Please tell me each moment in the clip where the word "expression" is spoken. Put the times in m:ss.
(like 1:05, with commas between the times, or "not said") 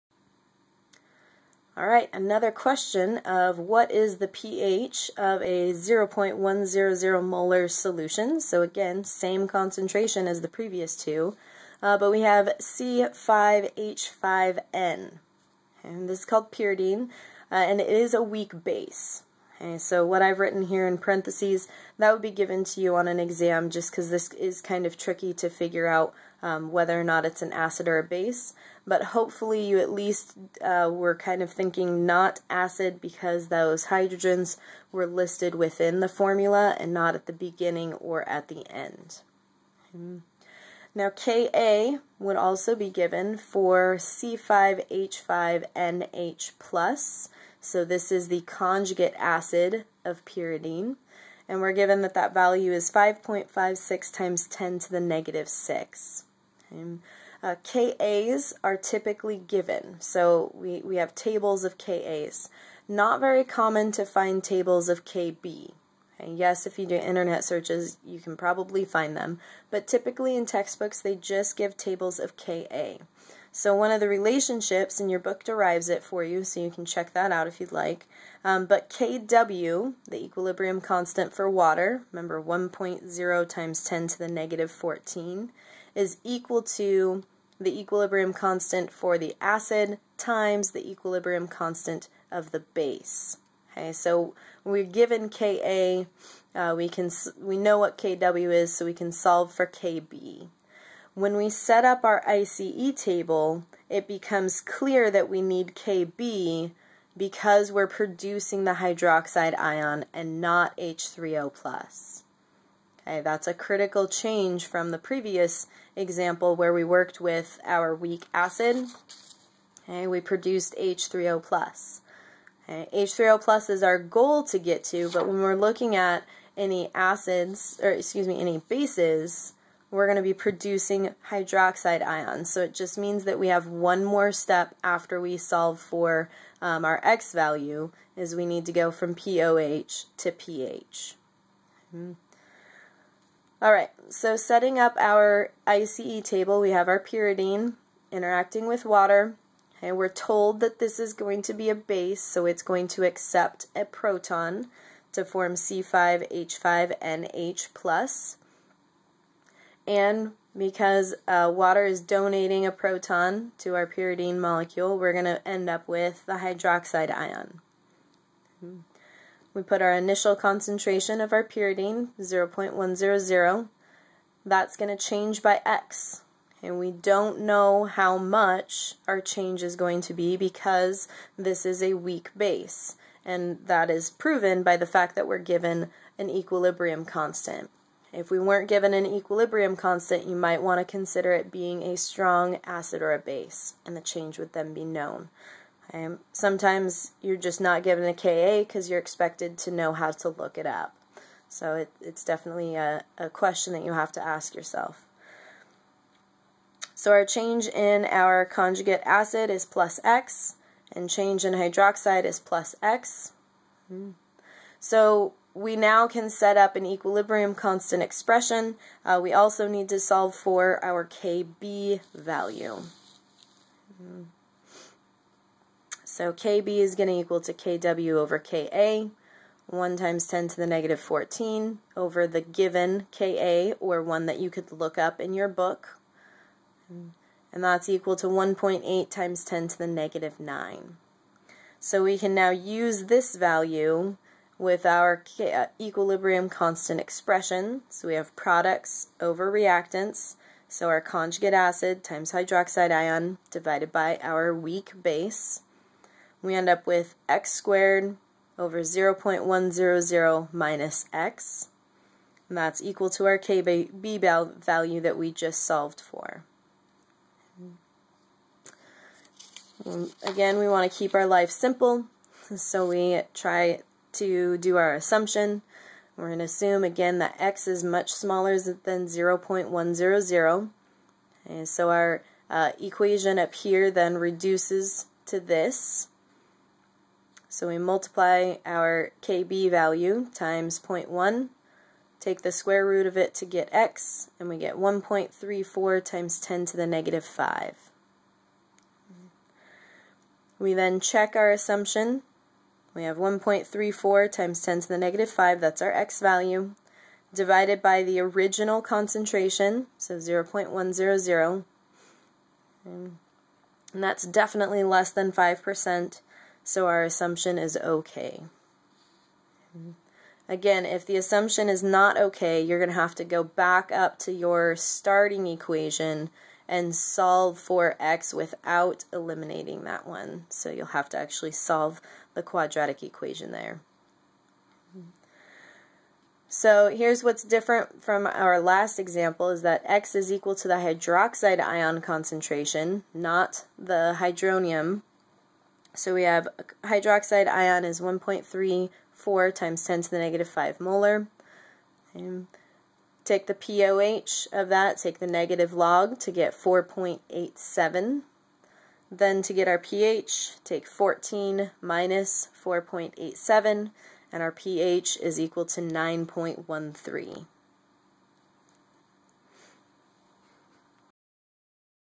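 3:38, 4:07.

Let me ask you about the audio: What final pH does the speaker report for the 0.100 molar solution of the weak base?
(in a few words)
9.13.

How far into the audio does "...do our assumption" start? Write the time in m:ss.
4:34.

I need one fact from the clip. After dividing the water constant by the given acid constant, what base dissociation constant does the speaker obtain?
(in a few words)
1.8 × 10^-9.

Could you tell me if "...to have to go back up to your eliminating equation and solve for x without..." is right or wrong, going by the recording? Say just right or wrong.
wrong.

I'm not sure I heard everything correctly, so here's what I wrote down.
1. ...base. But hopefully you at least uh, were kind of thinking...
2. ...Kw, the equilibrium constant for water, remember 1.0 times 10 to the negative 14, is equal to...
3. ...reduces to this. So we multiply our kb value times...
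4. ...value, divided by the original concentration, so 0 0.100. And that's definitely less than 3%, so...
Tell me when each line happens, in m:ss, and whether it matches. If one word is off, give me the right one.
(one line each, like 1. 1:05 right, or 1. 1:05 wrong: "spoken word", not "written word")
1. 0:28 right
2. 1:18 right
3. 4:44 right
4. 5:06 wrong: "5", not "3".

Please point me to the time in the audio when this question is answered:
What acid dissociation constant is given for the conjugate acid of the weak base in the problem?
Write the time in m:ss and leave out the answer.
0:52.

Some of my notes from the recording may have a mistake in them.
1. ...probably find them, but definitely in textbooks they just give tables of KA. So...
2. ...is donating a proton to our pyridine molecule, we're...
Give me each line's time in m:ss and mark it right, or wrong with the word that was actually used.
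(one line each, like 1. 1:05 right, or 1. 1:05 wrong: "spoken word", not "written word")
1. 1:08 wrong: "typically", not "definitely"
2. 2:41 right.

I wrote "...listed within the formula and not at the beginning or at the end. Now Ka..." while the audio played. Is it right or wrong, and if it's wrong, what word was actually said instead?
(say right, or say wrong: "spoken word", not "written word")
right.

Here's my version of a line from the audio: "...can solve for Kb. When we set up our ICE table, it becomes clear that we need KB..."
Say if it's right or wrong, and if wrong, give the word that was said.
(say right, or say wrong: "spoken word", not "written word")
right.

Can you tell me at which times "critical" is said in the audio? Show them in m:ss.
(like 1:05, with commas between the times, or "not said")
1:53.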